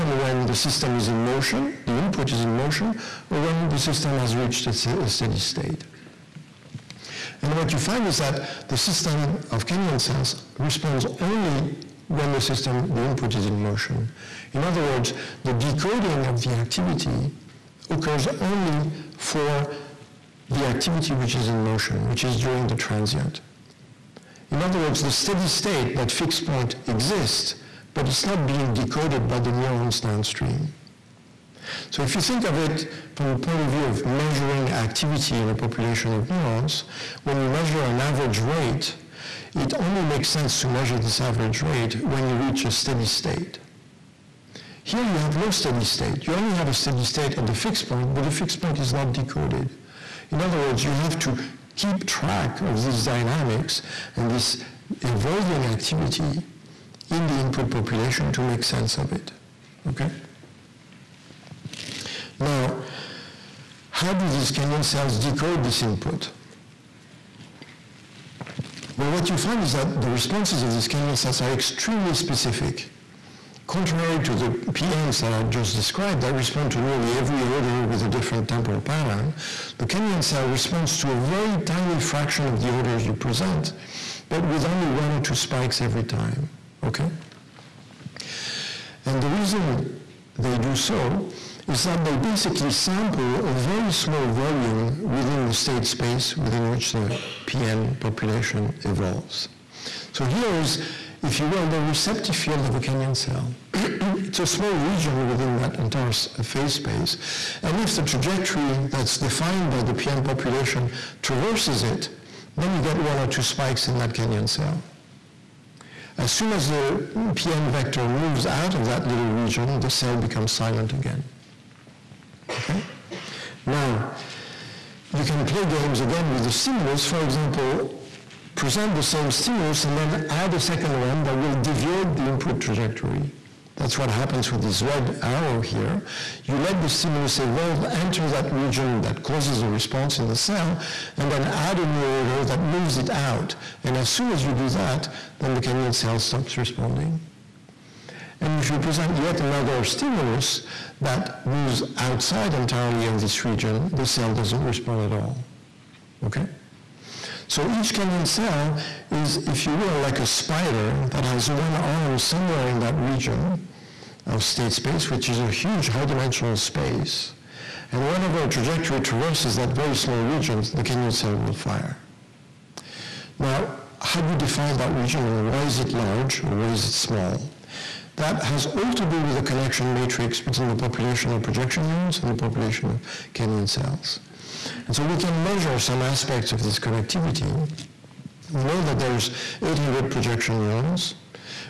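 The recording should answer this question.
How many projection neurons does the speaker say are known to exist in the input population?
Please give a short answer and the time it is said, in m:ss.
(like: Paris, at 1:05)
800, at 3:09.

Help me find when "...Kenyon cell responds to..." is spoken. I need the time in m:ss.
1:19.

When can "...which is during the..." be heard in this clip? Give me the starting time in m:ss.
0:22.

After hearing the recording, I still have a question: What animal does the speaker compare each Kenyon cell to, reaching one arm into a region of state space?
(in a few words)
A spider.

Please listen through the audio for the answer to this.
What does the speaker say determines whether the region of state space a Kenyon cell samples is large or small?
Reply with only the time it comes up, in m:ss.
2:59.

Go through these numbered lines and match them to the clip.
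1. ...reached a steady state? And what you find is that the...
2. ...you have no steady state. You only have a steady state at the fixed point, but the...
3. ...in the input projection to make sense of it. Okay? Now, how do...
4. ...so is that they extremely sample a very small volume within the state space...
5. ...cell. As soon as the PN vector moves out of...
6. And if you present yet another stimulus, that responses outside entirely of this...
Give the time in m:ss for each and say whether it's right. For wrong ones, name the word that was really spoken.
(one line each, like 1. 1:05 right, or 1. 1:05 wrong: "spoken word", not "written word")
1. 0:04 right
2. 0:45 right
3. 0:57 wrong: "population", not "projection"
4. 1:30 wrong: "basically", not "extremely"
5. 1:54 right
6. 2:28 wrong: "moves", not "responses".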